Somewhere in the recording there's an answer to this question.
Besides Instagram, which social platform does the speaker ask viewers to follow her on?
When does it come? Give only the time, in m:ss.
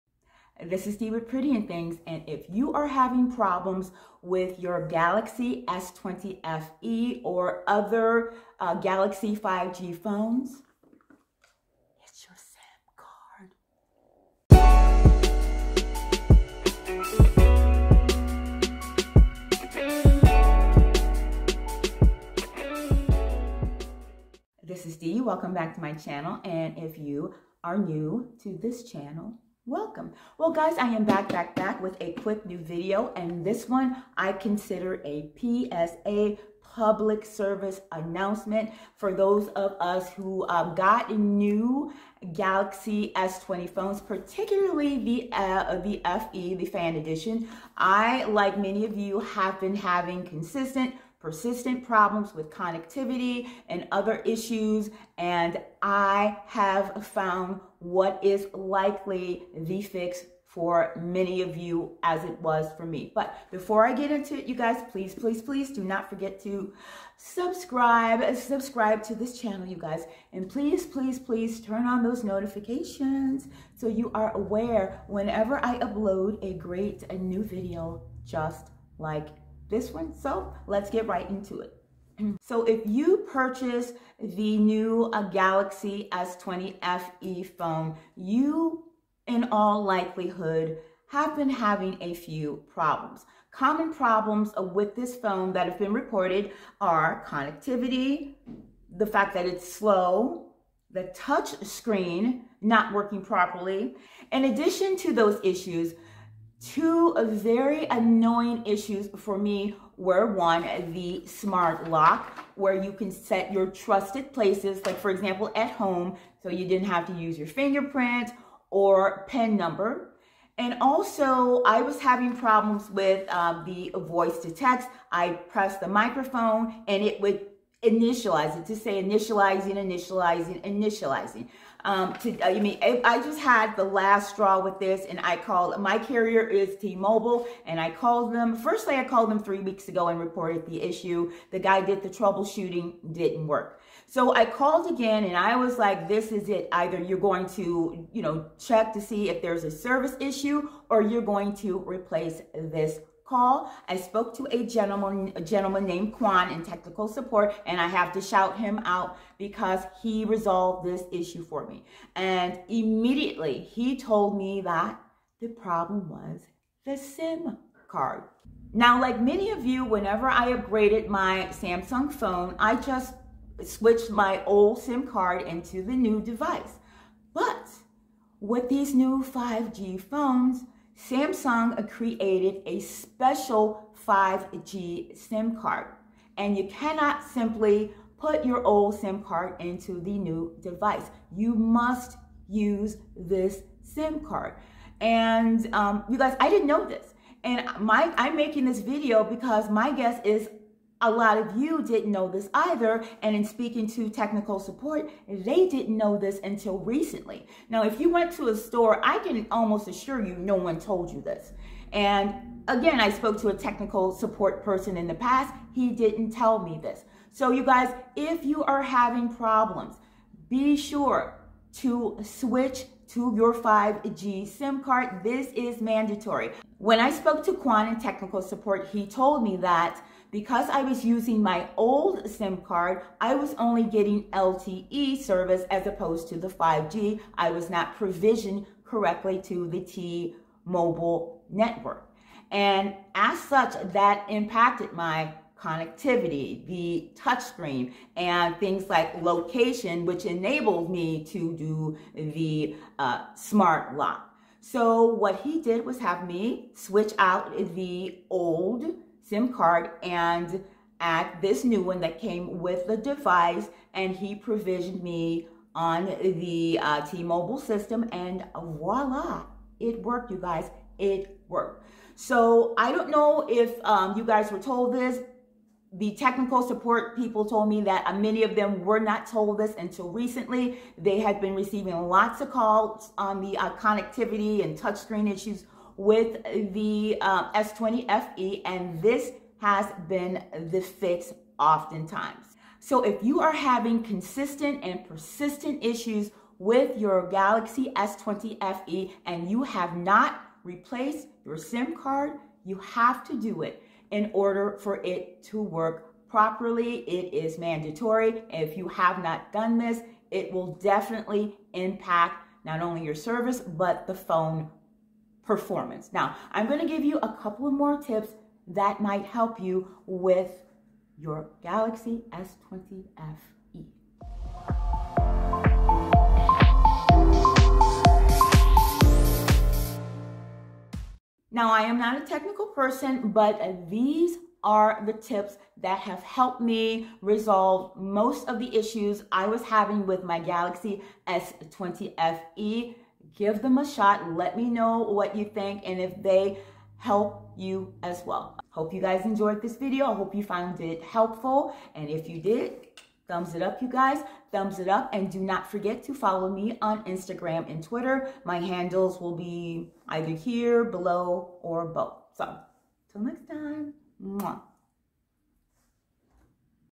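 5:57.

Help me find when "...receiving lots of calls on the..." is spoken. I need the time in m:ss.
4:41.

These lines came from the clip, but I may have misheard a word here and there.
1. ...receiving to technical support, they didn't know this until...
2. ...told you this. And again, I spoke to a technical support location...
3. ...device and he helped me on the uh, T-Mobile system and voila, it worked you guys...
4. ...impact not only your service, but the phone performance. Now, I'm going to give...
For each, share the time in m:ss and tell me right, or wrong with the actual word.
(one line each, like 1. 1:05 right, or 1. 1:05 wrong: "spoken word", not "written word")
1. 3:23 wrong: "speaking", not "receiving"
2. 3:30 wrong: "person", not "location"
3. 4:22 wrong: "provisioned", not "helped"
4. 5:11 right.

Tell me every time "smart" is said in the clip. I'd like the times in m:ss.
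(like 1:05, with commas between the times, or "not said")
1:51, 4:13.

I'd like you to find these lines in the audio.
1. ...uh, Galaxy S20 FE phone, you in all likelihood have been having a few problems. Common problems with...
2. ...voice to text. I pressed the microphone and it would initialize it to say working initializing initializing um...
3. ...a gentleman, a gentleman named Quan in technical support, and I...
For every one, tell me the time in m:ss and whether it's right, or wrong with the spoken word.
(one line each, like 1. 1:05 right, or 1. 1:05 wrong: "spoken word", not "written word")
1. 1:25 right
2. 2:03 wrong: "initializing", not "working"
3. 2:34 right.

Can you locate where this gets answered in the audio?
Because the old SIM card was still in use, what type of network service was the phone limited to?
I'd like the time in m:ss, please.
3:54.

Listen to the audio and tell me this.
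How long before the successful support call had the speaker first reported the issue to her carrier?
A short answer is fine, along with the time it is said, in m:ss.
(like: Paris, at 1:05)
three weeks, at 2:19.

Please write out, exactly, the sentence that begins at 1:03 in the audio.
But before I get into it, you guys, please, please, please do not forget to subscribe, subscribe to this channel, you guys.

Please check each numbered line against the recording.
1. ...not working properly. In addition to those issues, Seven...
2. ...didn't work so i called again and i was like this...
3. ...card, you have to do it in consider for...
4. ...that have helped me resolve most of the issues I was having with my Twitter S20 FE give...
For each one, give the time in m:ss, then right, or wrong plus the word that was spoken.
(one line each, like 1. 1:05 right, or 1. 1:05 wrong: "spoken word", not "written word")
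1. 1:42 wrong: "Two", not "Seven"
2. 2:23 right
3. 5:01 wrong: "order", not "consider"
4. 5:35 wrong: "Galaxy", not "Twitter".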